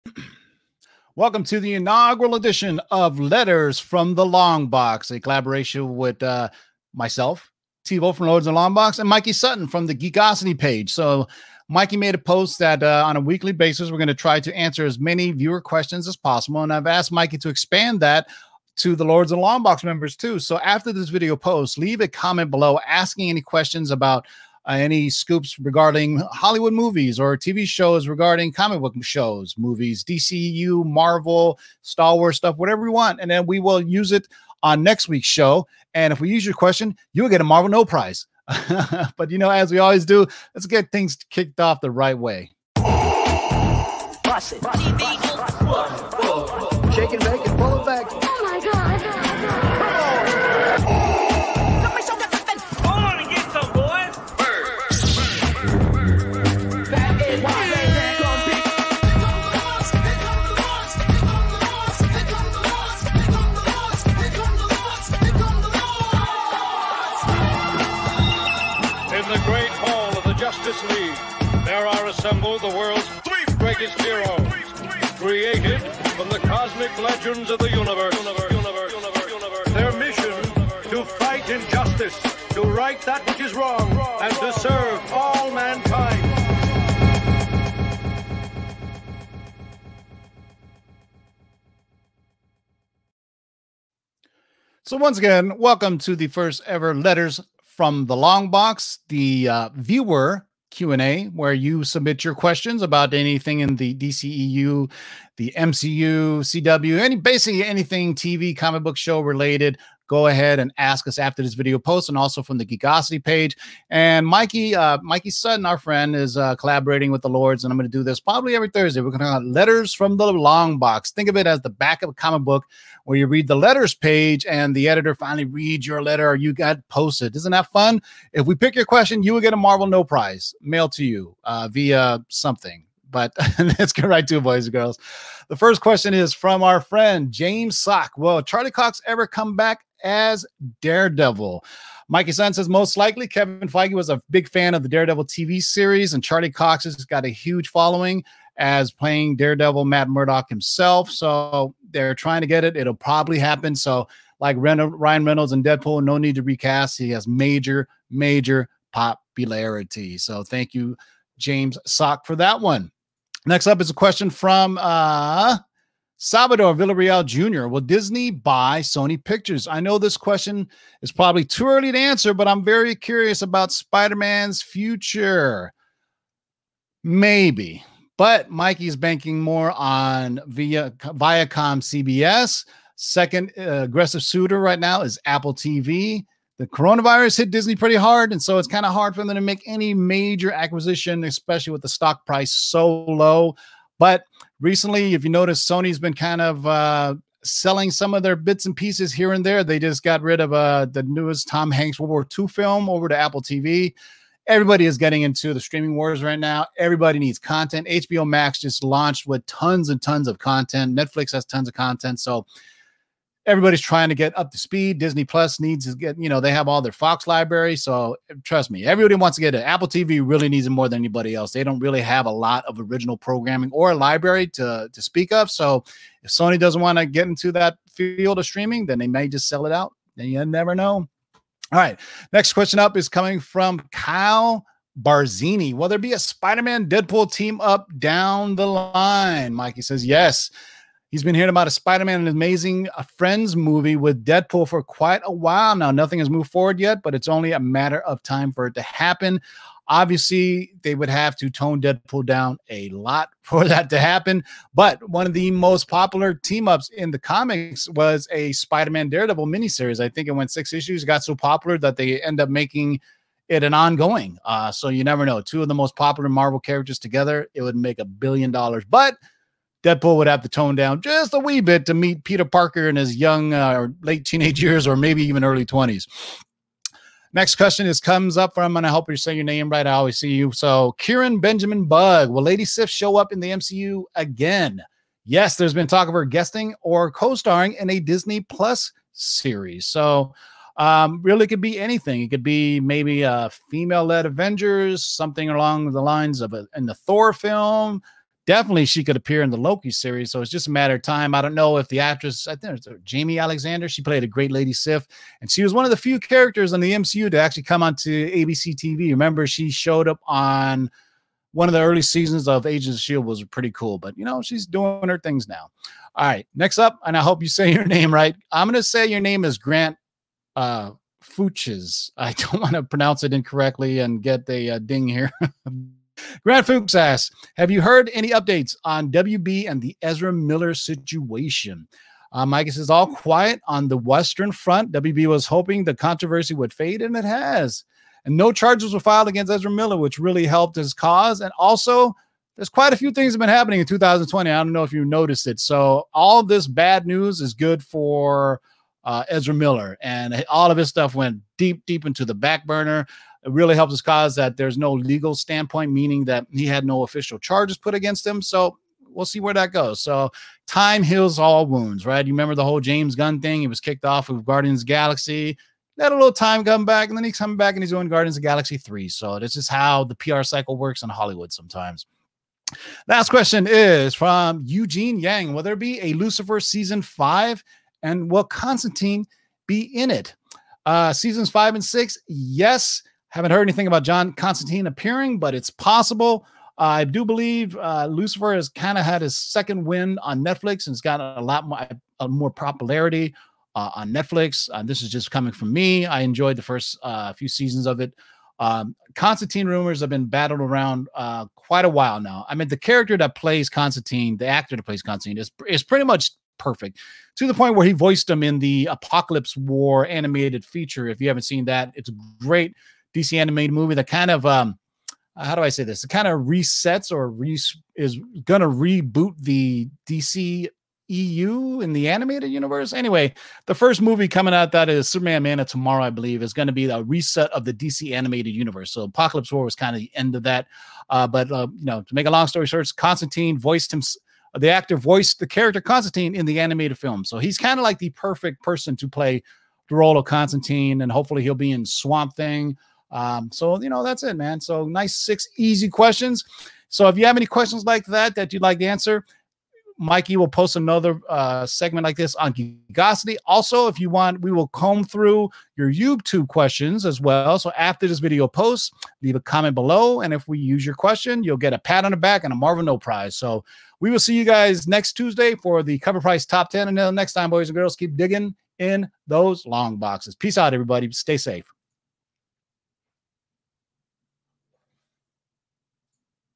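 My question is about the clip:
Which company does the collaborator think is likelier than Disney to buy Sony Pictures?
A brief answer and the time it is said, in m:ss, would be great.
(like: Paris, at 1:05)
Viacom CBS, at 3:00.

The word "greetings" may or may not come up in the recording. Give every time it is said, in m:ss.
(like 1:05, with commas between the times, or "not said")
not said.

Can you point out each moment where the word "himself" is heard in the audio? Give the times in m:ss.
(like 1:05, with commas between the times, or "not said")
2:30.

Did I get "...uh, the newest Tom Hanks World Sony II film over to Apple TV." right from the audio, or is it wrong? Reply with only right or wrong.
wrong.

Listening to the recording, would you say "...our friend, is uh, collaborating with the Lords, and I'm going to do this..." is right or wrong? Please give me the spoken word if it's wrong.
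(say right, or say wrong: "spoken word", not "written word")
right.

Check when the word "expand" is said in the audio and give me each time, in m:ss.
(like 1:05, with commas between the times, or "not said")
0:17.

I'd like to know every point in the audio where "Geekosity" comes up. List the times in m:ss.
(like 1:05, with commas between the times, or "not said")
0:09, 1:52, 7:32.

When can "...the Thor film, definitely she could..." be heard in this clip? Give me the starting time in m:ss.
4:56.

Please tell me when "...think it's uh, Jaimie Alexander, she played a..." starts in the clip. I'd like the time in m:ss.
5:02.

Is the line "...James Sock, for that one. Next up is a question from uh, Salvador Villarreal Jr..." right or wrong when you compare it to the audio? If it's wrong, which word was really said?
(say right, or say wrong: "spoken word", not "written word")
right.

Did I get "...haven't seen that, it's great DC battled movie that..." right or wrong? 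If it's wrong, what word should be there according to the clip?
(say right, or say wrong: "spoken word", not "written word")
wrong: "animated", not "battled".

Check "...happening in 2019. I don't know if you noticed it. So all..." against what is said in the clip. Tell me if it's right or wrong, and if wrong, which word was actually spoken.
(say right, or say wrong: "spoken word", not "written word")
wrong: "2020", not "2019".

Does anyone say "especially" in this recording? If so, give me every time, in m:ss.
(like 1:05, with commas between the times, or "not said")
3:11.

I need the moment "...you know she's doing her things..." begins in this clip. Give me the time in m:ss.
5:14.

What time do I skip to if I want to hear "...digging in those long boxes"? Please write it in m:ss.
7:48.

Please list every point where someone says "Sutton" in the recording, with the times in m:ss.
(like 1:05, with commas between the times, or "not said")
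0:09, 1:55, 2:22.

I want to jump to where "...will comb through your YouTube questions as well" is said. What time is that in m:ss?
7:34.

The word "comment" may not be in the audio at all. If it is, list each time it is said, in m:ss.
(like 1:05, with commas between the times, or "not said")
0:22, 7:39.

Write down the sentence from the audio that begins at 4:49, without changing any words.
So, um, really could be anything.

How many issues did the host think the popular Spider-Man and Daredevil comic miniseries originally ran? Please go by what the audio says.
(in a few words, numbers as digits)
6.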